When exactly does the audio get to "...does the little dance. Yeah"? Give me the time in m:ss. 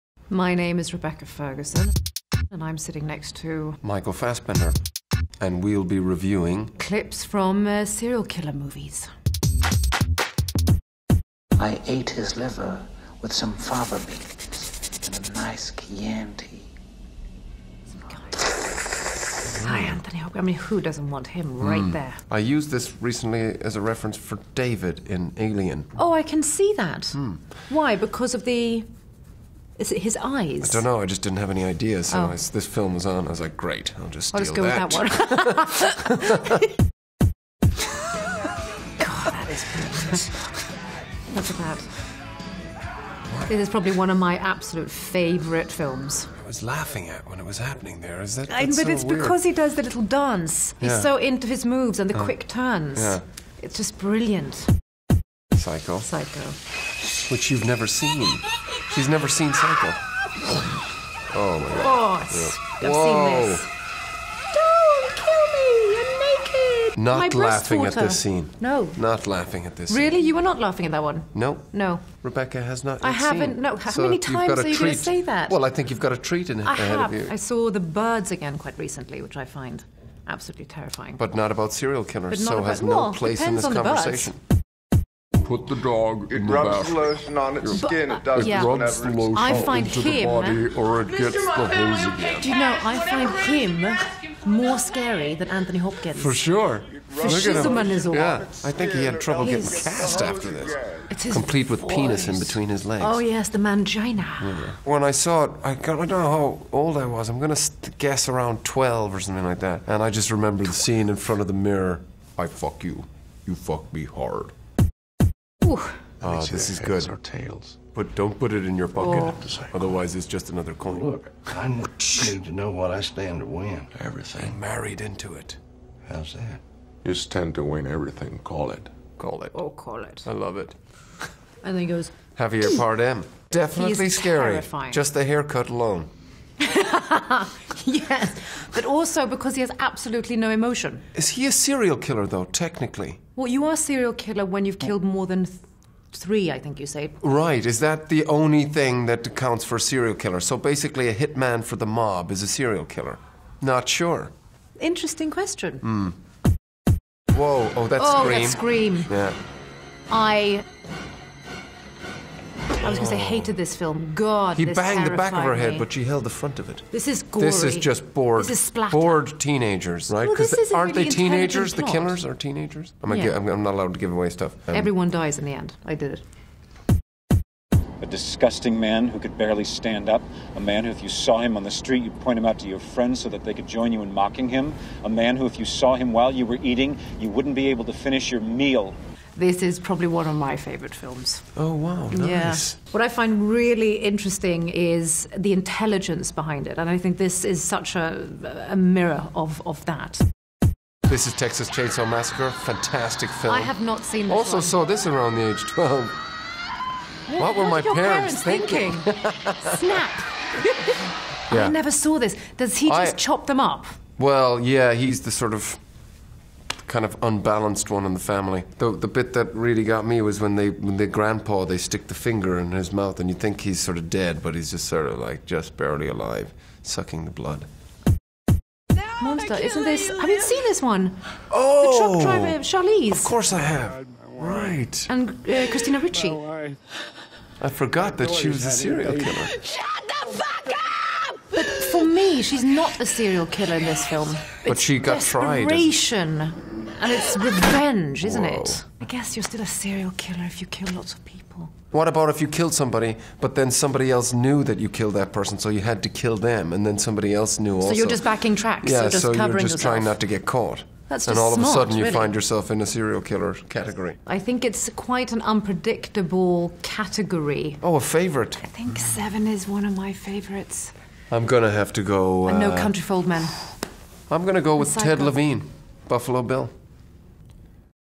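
0:49.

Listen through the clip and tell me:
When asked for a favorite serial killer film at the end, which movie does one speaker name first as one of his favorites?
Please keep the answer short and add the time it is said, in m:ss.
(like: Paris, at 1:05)
Seven, at 4:28.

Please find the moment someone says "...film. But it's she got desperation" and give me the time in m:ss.
4:04.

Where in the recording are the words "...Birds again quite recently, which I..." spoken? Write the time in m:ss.
1:17.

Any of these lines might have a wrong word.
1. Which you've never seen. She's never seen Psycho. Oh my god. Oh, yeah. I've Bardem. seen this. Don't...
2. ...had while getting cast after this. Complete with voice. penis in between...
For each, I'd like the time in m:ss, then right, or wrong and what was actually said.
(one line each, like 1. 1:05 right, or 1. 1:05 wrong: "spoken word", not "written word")
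1. 0:57 wrong: "Whoa", not "Bardem"
2. 1:39 wrong: "trouble", not "while".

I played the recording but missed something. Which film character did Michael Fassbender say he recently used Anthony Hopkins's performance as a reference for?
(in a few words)
David in Alien.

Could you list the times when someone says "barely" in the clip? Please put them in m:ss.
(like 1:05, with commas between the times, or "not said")
2:59, 3:45.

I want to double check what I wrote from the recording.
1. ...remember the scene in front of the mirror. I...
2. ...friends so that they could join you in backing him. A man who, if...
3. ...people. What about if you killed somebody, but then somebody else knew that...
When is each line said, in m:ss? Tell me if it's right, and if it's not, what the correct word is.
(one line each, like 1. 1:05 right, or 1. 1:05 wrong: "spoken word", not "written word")
1. 1:50 right
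2. 3:02 wrong: "mocking", not "backing"
3. 4:11 right.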